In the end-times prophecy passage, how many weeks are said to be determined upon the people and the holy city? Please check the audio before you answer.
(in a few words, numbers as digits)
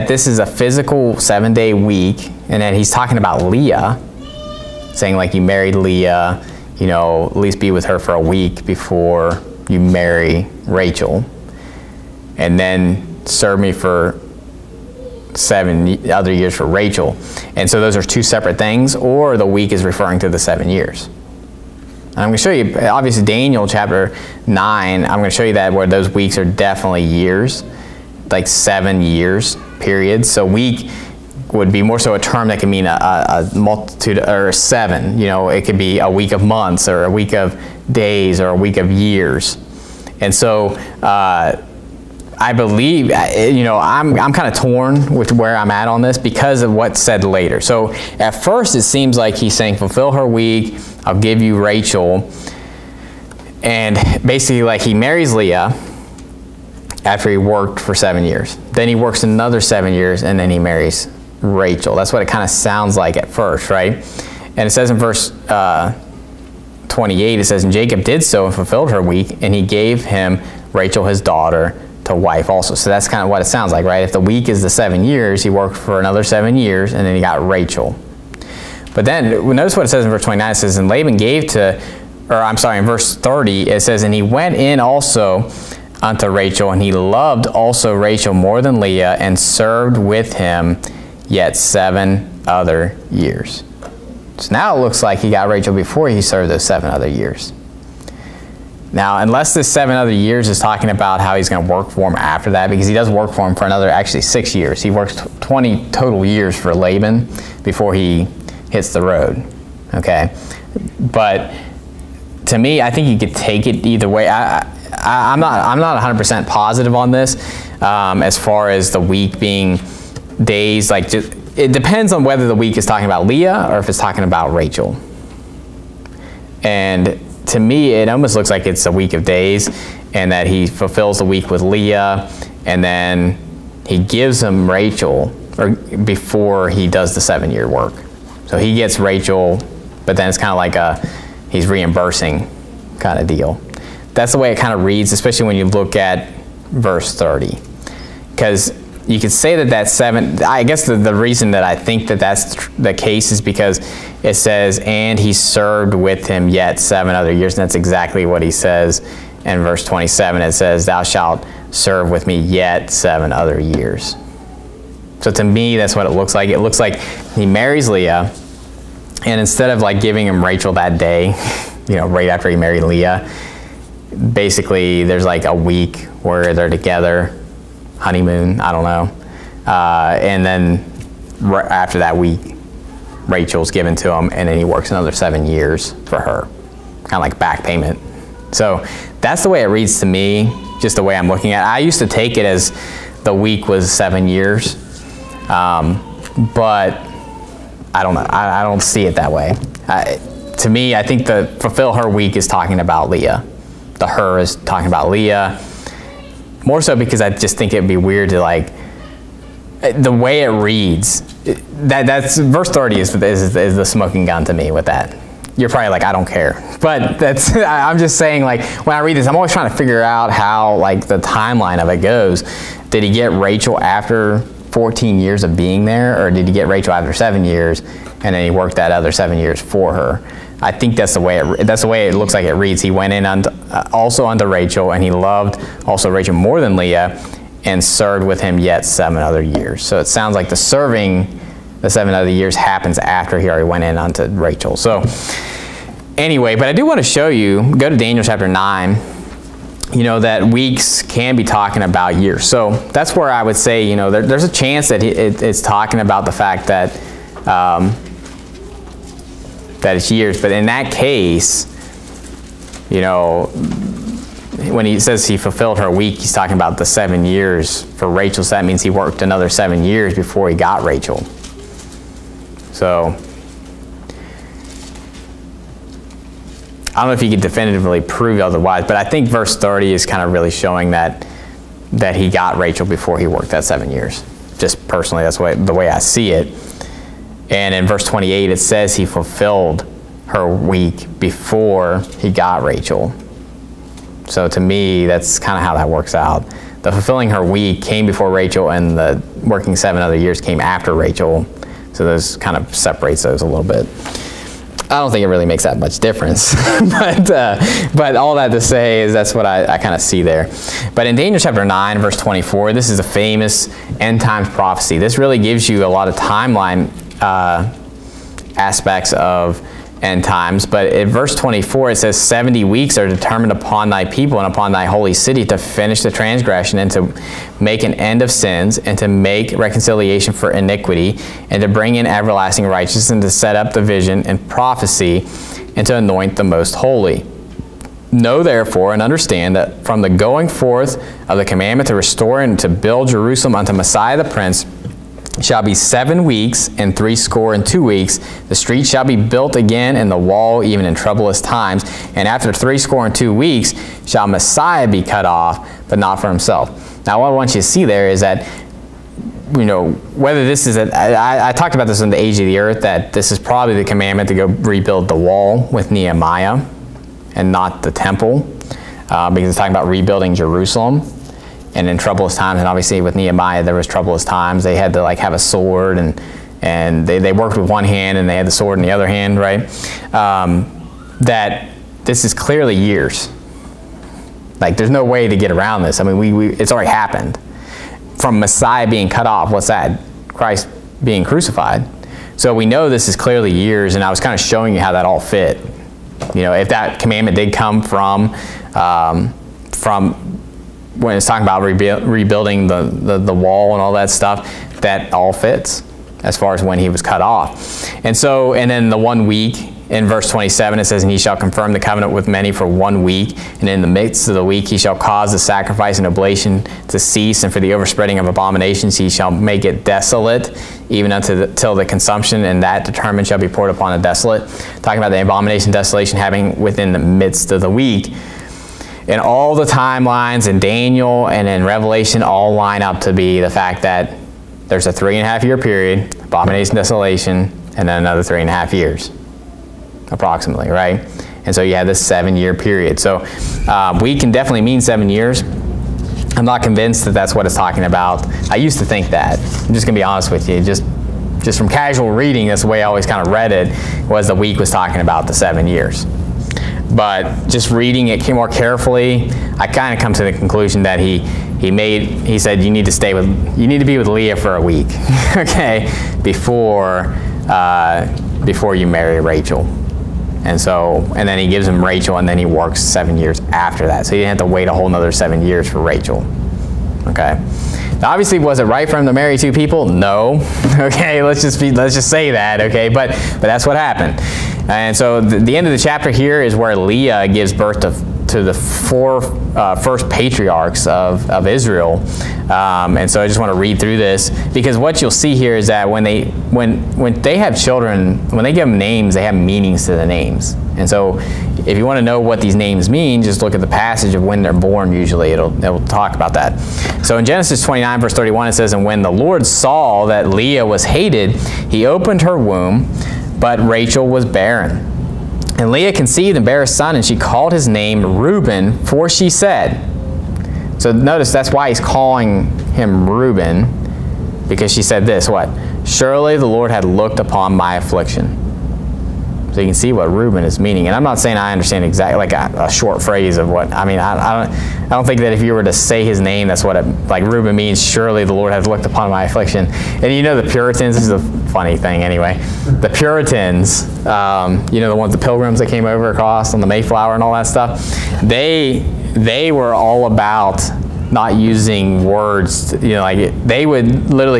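70.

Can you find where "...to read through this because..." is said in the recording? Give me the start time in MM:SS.
08:13.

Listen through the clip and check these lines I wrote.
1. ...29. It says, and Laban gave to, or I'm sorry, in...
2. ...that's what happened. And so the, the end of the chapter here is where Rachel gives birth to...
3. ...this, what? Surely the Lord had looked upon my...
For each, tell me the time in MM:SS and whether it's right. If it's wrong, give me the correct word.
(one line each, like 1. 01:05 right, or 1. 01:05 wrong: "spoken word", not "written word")
1. 01:20 right
2. 08:03 wrong: "Leah", not "Rachel"
3. 08:45 right.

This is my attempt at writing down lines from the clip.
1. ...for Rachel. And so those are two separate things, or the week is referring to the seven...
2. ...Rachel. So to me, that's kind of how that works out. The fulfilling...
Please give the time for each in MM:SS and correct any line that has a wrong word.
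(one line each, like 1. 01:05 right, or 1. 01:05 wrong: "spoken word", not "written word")
1. 00:16 right
2. 04:52 right.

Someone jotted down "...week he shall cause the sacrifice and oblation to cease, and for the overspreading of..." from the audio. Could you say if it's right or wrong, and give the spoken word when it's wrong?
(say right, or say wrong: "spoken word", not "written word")
right.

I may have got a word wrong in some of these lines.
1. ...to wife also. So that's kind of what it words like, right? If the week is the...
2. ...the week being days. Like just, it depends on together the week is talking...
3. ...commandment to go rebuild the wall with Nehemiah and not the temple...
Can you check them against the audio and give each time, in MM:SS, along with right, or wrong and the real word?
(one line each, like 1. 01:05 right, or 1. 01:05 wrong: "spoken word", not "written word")
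1. 01:12 wrong: "sounds", not "words"
2. 01:58 wrong: "whether", not "together"
3. 06:03 right.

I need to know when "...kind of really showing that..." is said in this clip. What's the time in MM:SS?
04:40.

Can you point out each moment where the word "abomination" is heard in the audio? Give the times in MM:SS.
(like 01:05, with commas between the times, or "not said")
06:58, 07:05, 07:16.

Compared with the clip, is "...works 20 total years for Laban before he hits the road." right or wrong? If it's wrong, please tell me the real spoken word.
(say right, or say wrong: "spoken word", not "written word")
right.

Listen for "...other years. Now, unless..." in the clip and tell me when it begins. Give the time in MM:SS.
01:36.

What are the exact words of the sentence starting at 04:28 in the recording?
So that means he worked another seven years before he got Rachel.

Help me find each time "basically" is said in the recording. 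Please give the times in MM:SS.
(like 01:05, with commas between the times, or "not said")
00:54, 02:54.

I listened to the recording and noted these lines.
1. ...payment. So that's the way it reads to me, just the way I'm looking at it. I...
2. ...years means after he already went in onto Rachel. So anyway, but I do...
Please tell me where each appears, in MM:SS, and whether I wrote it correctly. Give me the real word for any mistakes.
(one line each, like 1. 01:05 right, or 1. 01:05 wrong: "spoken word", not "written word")
1. 03:07 right
2. 04:02 wrong: "happens", not "means".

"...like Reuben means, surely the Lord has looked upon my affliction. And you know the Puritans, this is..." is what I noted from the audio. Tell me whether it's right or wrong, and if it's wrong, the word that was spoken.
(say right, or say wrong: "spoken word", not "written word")
right.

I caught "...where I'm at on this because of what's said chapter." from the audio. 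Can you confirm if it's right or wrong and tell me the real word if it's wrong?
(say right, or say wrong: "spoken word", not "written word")
wrong: "later", not "chapter".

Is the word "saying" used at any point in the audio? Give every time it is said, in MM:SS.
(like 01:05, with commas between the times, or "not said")
00:04, 00:49, 03:38, 08:51.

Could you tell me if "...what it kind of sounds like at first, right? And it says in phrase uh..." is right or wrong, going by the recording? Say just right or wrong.
wrong.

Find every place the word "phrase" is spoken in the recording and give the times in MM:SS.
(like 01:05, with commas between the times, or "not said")
08:53.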